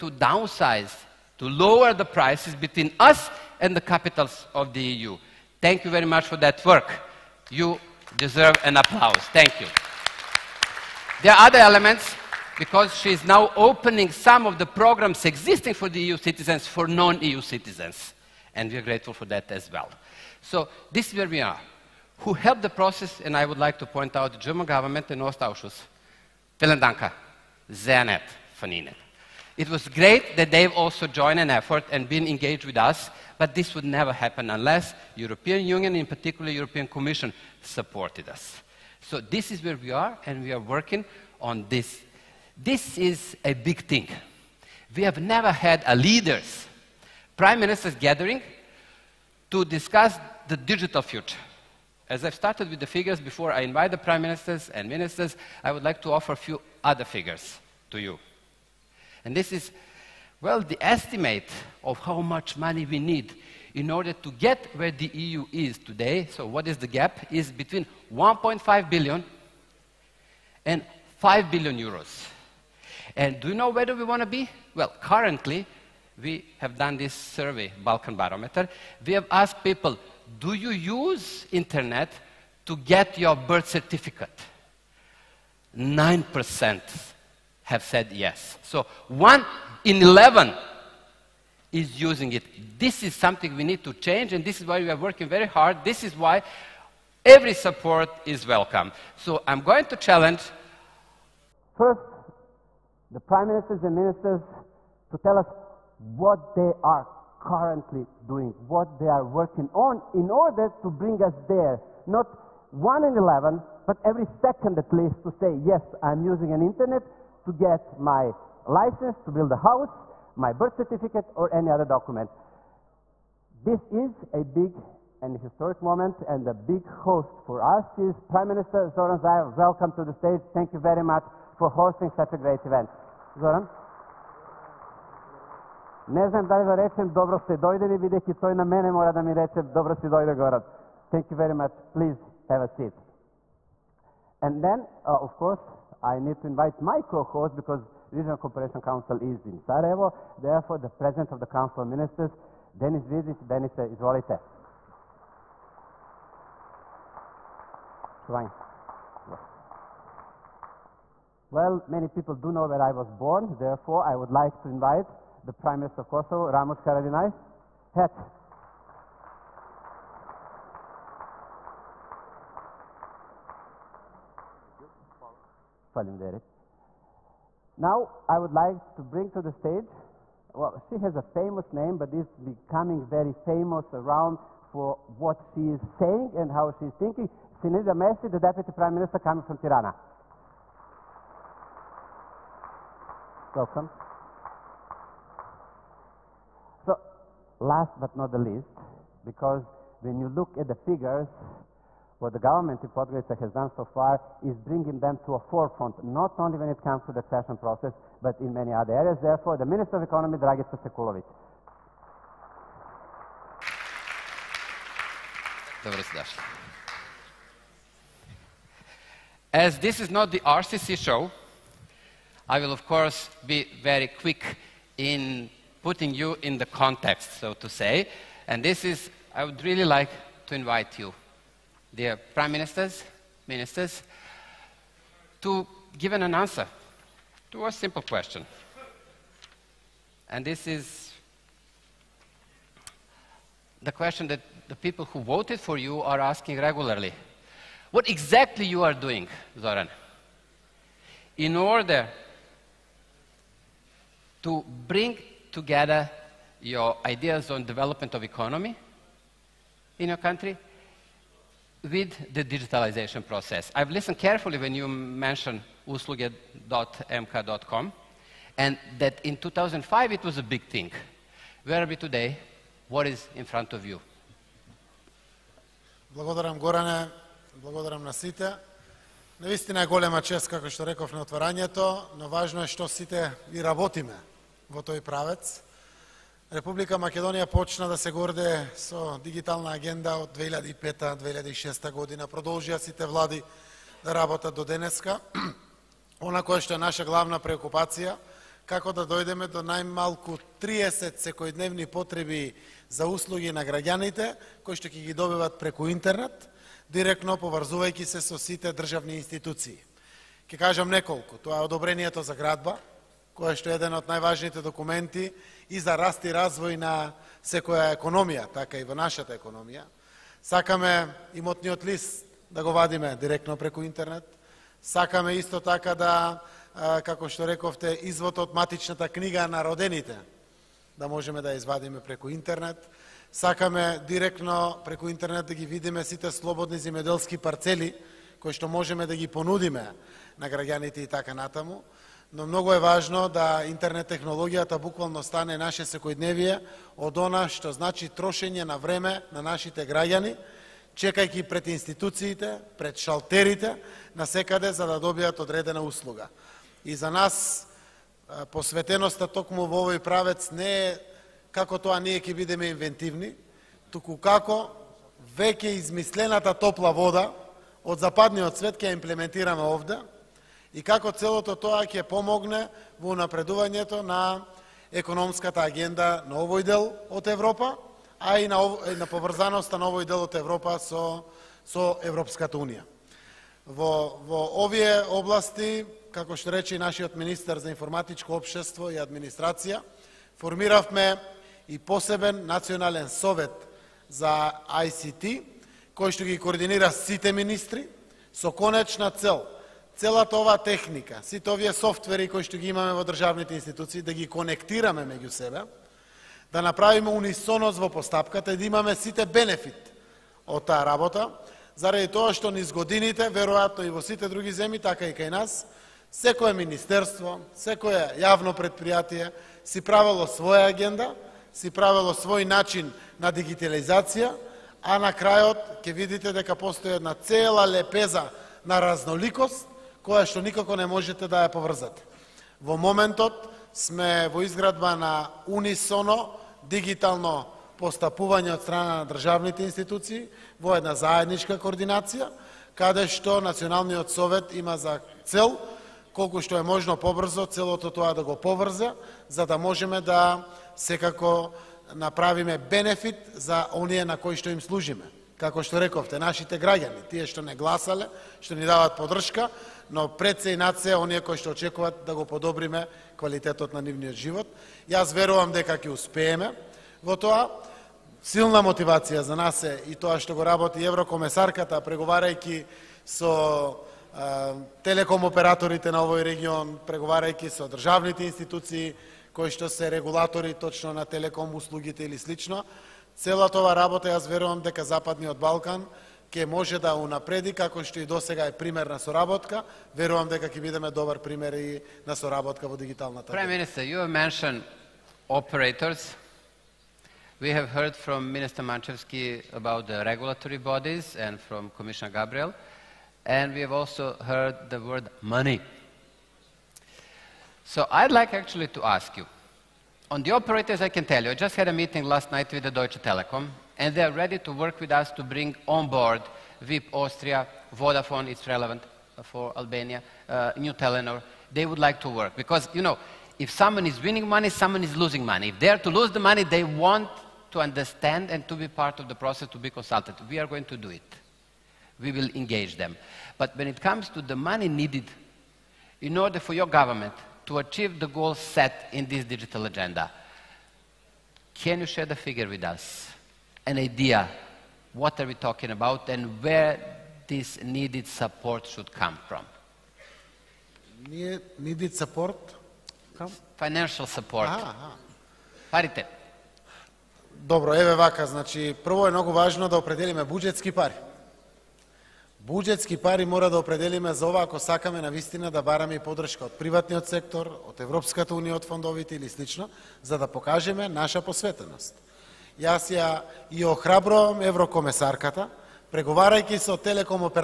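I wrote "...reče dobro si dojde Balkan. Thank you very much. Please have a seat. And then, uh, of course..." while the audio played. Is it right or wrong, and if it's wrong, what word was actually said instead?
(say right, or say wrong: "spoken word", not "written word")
wrong: "Goran", not "Balkan".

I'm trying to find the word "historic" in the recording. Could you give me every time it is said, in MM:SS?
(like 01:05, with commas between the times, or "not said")
02:05.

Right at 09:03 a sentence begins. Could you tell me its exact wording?
an idea what are we talking about and where this needed support should come from.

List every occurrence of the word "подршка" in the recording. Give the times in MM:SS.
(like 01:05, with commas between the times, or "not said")
07:38, 09:25.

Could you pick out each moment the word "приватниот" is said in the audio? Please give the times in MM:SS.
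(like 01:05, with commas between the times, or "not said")
09:26.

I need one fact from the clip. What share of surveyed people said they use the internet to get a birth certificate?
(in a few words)
9%.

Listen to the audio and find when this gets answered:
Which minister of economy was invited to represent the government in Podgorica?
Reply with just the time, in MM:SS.
03:30.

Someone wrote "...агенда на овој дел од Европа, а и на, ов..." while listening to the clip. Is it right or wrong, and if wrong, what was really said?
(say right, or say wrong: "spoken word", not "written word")
right.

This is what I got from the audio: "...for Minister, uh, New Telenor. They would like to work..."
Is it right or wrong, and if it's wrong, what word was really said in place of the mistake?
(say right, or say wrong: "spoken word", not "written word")
wrong: "Albania", not "Minister".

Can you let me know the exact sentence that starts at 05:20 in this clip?
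Сакаме имотниот лист да го вадиме директно преку интернет.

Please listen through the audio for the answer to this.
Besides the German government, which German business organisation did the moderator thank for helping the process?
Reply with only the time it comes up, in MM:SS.
00:25.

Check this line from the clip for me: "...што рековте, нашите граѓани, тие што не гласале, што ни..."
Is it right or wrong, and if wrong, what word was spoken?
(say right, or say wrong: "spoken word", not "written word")
right.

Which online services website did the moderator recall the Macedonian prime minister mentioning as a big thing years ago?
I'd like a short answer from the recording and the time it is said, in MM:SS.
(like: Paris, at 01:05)
usluge.mk.com, at 04:25.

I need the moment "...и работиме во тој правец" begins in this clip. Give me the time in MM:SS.
04:43.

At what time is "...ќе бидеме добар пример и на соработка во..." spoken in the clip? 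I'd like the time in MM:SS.
08:10.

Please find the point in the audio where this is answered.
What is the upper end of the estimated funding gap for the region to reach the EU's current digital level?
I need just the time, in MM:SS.
01:11.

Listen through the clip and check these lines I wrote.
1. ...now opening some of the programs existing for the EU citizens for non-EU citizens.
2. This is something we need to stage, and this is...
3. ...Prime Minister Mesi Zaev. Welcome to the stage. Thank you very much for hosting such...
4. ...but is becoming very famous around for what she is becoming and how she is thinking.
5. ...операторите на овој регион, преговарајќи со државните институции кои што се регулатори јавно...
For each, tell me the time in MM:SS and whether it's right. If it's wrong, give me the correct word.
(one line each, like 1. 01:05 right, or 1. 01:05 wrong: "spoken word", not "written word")
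1. 00:13 right
2. 01:32 wrong: "change", not "stage"
3. 02:08 wrong: "Zoran", not "Mesi"
4. 03:01 wrong: "saying", not "becoming"
5. 07:55 wrong: "точно", not "јавно".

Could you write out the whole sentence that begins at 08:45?
If they are to lose the money, they want to understand and to be part of the process, to be consulted.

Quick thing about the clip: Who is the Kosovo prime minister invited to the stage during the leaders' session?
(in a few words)
Ramush Haradinaj.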